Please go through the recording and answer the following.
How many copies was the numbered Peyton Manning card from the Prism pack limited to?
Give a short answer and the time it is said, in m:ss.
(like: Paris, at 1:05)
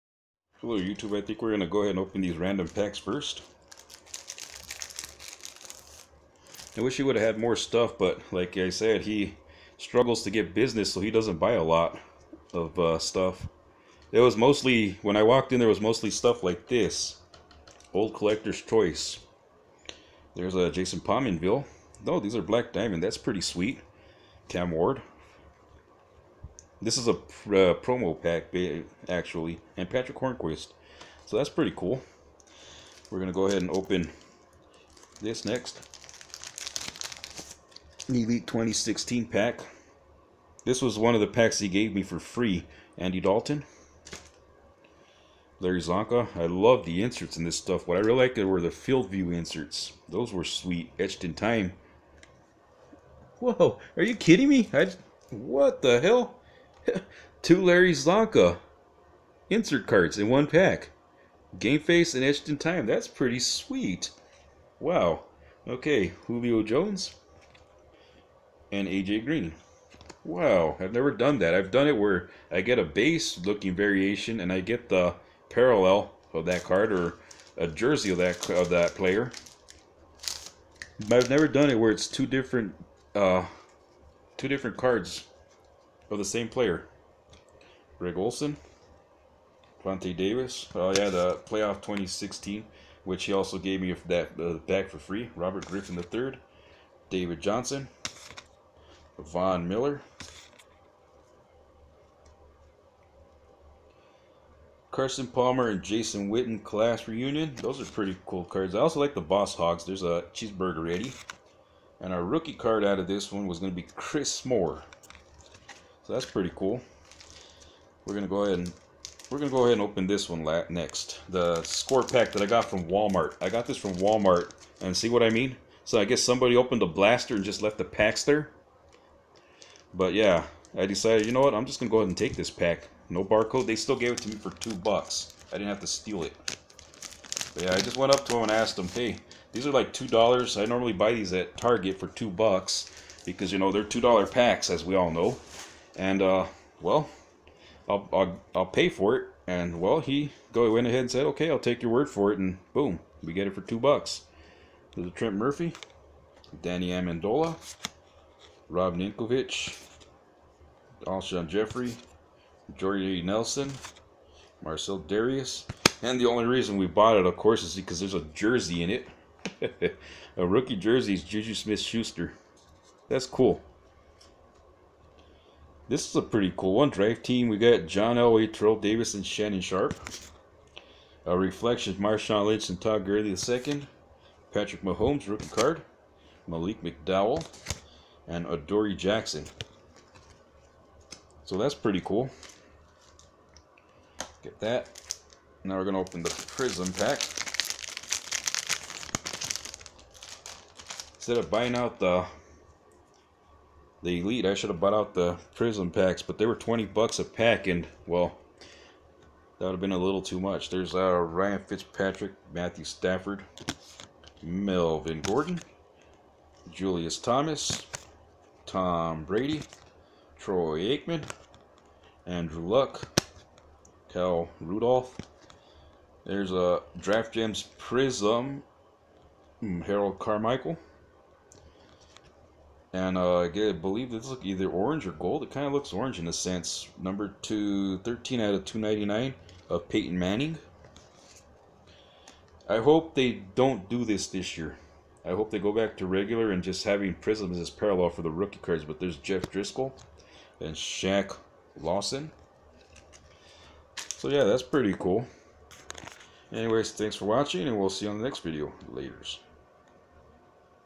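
299, at 3:58.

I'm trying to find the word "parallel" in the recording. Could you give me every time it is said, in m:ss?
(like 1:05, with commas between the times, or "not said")
1:15, 4:07.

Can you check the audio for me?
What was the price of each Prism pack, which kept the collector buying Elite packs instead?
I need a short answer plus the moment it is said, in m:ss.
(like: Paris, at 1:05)
$20, at 3:26.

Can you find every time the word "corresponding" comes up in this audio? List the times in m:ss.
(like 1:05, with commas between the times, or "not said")
not said.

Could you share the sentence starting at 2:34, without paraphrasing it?
There's a Trent Murphy, Danny Amendola, Rob Ninkovich, Alshon Jeffery, Jordy Nelson, Marcell Dareus.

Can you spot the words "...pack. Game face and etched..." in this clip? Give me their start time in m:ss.
1:00.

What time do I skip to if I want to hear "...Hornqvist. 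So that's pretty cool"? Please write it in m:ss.
0:30.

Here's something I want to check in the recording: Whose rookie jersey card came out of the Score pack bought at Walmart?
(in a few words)
Juju Smith Schuster.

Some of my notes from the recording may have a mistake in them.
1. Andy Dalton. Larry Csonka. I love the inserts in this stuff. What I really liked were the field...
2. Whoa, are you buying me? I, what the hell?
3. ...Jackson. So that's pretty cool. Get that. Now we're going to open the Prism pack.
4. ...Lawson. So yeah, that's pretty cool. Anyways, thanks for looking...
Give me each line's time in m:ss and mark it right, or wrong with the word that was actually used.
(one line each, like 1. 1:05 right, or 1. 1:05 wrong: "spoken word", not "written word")
1. 0:42 right
2. 0:53 wrong: "kidding", not "buying"
3. 3:08 right
4. 4:11 wrong: "watching", not "looking".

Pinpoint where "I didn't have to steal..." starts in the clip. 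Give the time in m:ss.
2:15.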